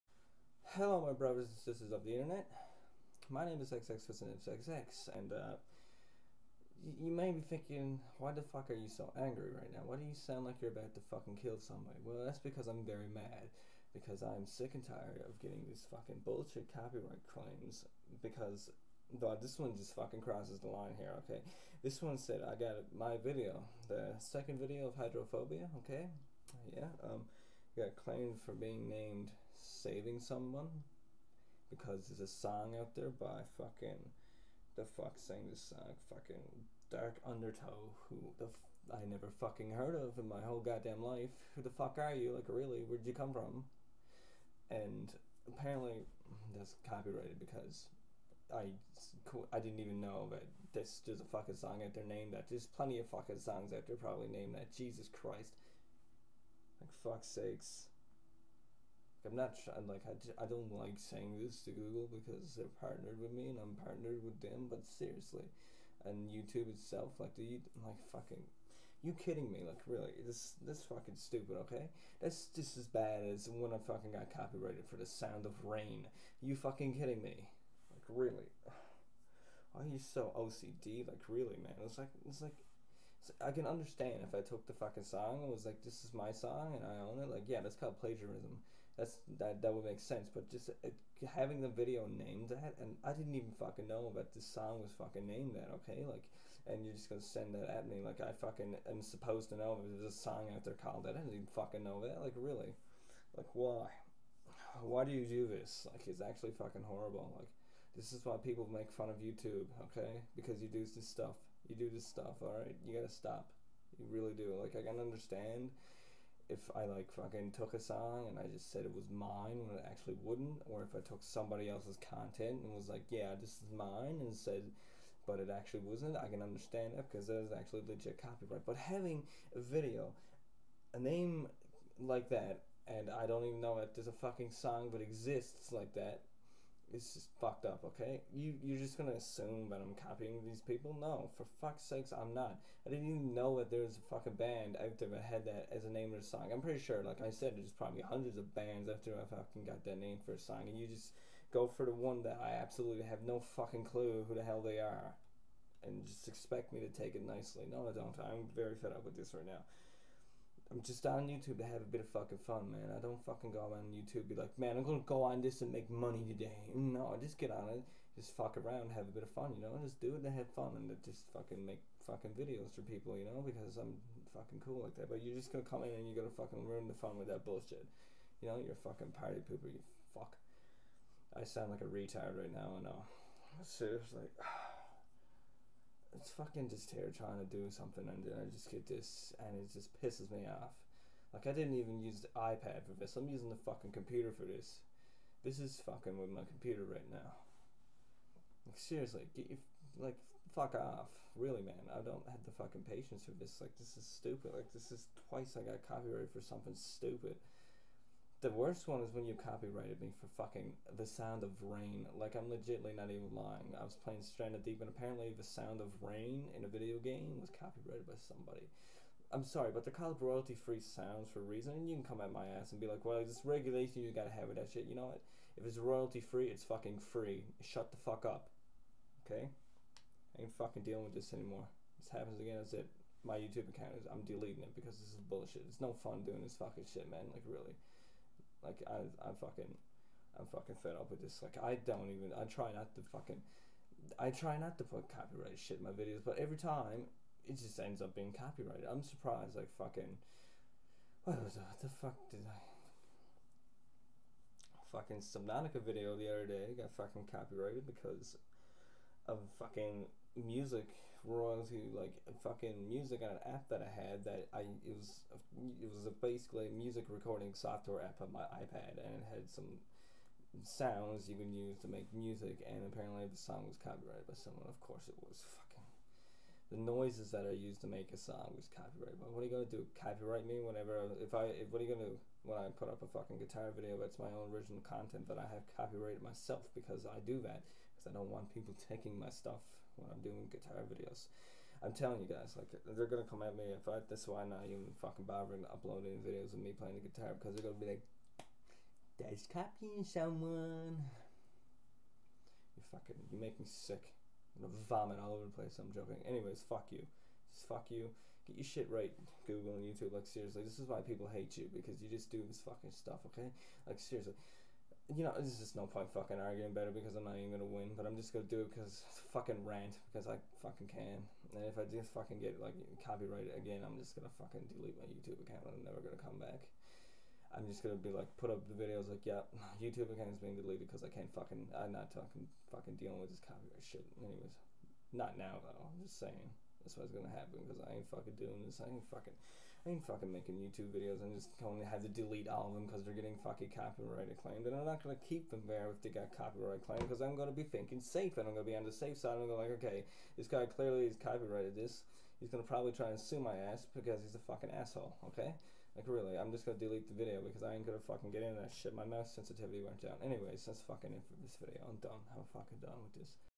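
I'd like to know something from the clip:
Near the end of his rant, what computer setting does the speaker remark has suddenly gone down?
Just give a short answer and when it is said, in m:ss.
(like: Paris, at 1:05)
mouse sensitivity, at 5:59.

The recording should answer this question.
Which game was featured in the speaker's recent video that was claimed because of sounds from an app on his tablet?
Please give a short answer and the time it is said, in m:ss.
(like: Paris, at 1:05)
Subnautica, at 4:15.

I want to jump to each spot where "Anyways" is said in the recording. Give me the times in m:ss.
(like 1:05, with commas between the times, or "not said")
5:06, 5:34, 6:00.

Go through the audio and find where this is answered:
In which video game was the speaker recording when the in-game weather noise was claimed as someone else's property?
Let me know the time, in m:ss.
3:34.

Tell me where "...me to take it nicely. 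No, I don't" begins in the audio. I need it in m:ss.
2:36.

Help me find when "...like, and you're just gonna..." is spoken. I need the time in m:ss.
1:36.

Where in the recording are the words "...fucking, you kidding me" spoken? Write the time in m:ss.
1:08.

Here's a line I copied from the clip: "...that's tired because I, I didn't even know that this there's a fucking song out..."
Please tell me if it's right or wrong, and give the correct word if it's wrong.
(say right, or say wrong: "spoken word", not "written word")
wrong: "copyrighted", not "tired".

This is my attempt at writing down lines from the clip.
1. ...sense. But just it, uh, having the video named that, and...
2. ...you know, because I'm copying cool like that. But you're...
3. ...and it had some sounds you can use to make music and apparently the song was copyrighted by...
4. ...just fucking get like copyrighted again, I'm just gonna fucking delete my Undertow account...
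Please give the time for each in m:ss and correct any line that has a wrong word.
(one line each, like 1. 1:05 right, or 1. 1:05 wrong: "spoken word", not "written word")
1. 1:29 right
2. 2:53 wrong: "fucking", not "copying"
3. 4:28 right
4. 5:21 wrong: "YouTube", not "Undertow".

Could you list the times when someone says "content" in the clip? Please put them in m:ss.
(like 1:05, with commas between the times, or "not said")
2:02, 4:44.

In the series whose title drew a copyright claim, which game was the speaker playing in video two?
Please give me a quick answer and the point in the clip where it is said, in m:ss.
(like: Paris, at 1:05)
Hydrophobia, at 0:24.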